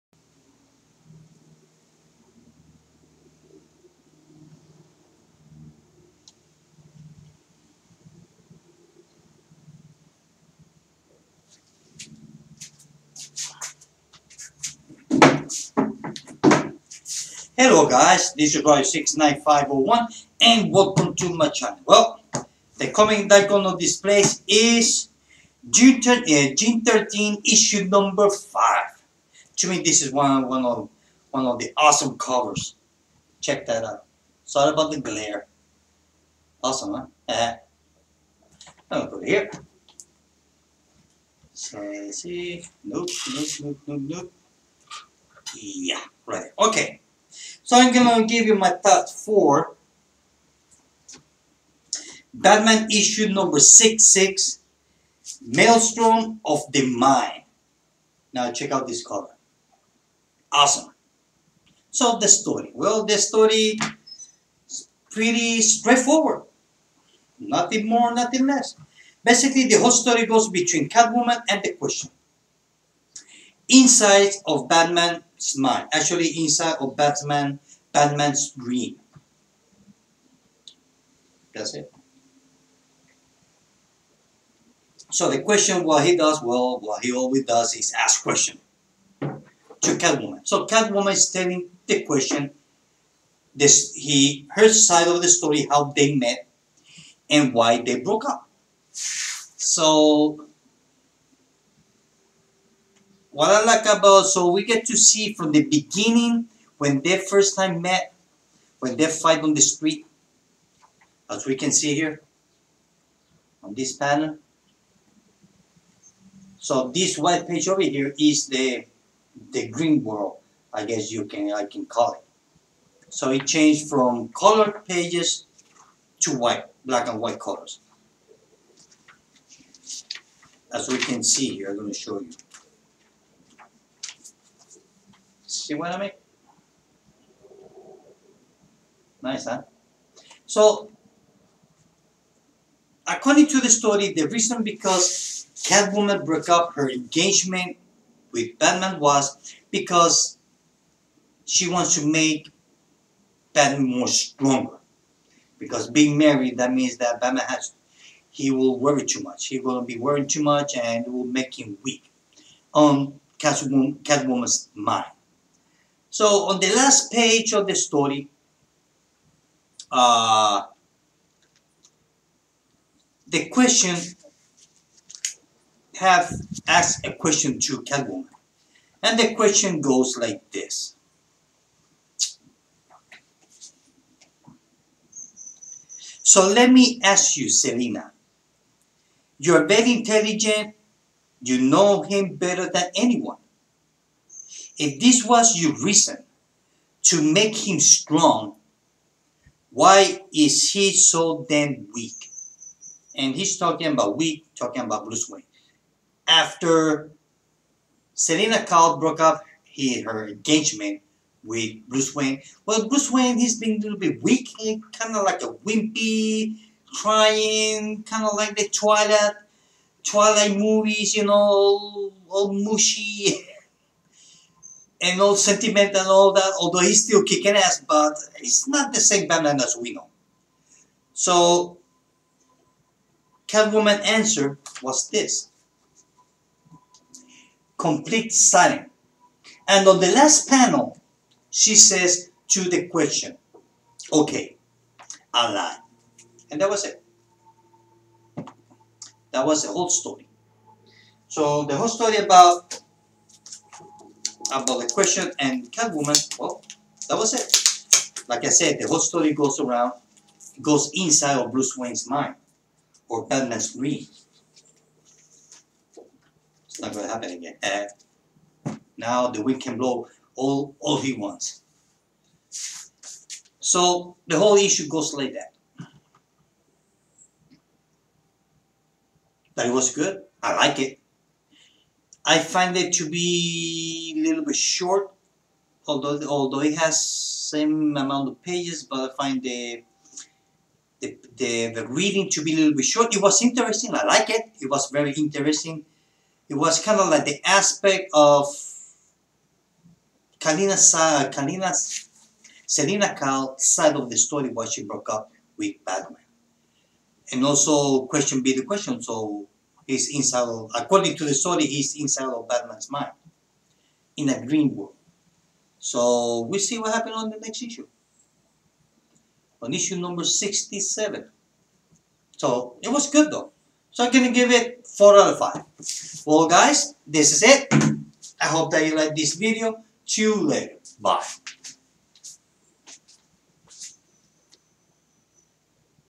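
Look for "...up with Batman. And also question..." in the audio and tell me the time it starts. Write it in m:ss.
5:05.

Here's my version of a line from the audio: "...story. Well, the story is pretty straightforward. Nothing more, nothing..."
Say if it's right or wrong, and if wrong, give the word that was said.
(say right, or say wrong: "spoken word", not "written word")
right.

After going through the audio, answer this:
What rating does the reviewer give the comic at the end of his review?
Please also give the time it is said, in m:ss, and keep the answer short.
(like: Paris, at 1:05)
4 out of 5, at 5:24.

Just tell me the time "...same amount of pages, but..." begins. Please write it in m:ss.
4:47.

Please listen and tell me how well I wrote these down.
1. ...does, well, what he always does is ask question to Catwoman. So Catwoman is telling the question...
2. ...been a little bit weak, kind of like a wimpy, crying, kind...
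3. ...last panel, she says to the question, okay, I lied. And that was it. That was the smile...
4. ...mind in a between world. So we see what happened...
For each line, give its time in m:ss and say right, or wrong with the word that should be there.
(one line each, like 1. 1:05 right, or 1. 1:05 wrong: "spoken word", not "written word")
1. 1:26 right
2. 3:33 right
3. 4:00 wrong: "whole", not "smile"
4. 5:12 wrong: "green", not "between".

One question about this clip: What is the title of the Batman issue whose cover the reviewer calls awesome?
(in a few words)
Maelstrom of the Mind.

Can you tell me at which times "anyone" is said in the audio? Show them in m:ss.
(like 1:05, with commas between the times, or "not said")
3:12.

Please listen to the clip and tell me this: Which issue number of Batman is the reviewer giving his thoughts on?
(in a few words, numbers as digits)
66.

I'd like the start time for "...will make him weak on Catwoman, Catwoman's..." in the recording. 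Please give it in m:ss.
2:41.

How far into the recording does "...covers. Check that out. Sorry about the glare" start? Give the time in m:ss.
0:32.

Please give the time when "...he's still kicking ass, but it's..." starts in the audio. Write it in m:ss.
3:46.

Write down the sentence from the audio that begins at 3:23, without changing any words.
And he's talking about weak, talking about Bruce Wayne.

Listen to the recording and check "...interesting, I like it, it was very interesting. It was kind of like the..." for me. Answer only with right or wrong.
right.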